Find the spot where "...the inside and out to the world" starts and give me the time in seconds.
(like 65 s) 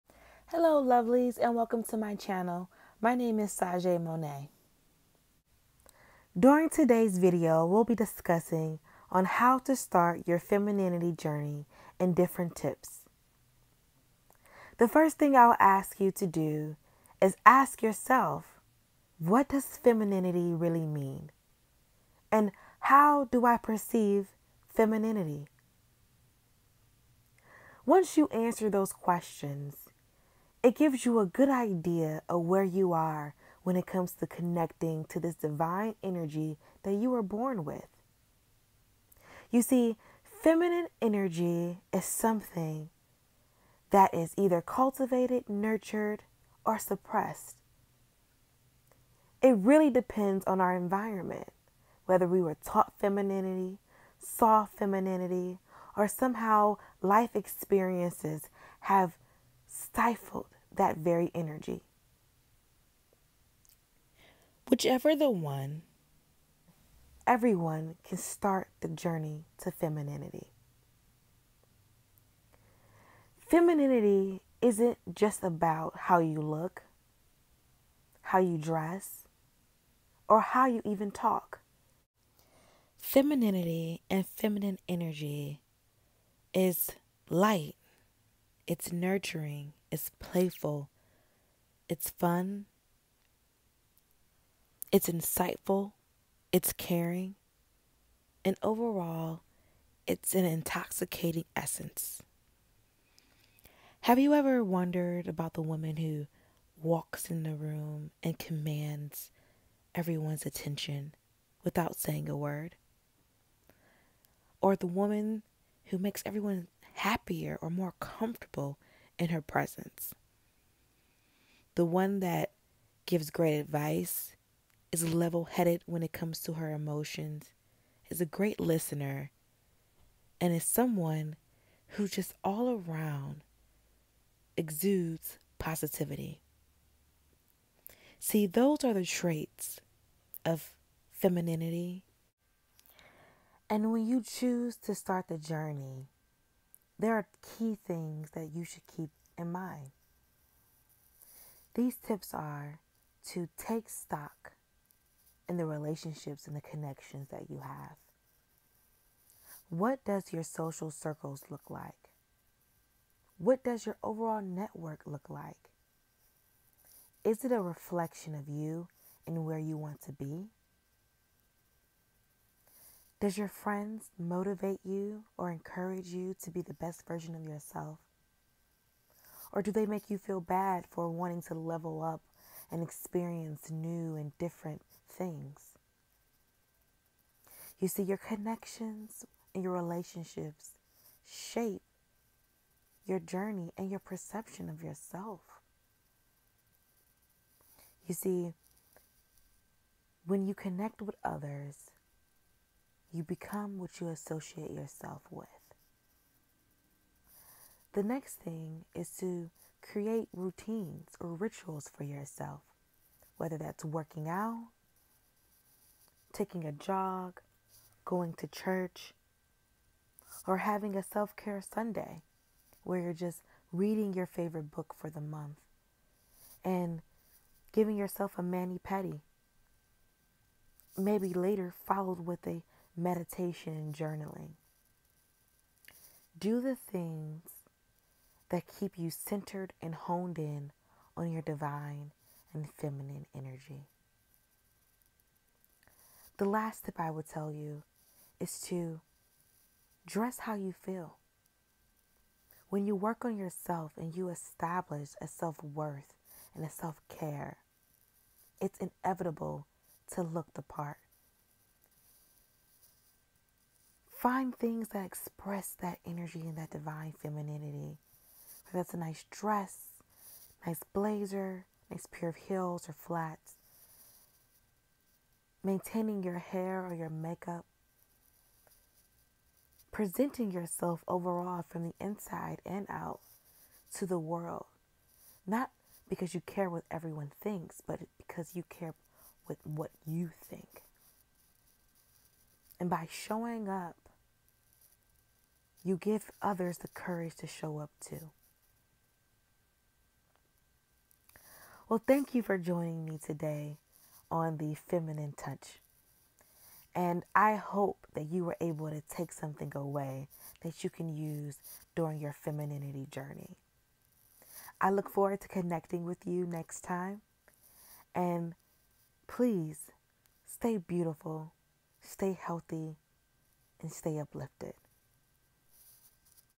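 281 s.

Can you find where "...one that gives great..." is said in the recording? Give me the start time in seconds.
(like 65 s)
121 s.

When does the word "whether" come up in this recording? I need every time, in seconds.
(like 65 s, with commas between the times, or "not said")
52 s, 213 s.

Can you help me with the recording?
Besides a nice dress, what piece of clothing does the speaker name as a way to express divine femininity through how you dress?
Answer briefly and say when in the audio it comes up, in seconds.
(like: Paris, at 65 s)
blazer, at 270 s.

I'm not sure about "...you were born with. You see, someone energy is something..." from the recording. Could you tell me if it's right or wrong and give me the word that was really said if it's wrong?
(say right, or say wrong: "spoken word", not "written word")
wrong: "feminine", not "someone".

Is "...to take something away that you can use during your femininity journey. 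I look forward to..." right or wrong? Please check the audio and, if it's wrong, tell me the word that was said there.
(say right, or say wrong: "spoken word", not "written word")
right.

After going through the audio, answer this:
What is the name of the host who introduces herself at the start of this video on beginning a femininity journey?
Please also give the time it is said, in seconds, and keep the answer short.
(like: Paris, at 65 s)
Sajeé Monaí, at 3 s.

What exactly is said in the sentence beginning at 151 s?
These tips are to take stock in the relationships and the connections that you have.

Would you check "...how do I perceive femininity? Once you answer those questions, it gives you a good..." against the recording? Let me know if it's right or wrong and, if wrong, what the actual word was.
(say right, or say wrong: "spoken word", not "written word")
right.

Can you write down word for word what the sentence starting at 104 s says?
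Have you ever wondered about the woman who walks in the room and commands everyone's attention without saying a word?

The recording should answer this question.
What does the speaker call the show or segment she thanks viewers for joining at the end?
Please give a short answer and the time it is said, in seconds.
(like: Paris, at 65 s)
the feminine touch, at 304 s.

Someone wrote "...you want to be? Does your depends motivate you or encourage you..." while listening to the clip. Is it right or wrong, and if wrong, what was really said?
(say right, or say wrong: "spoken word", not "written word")
wrong: "friends", not "depends".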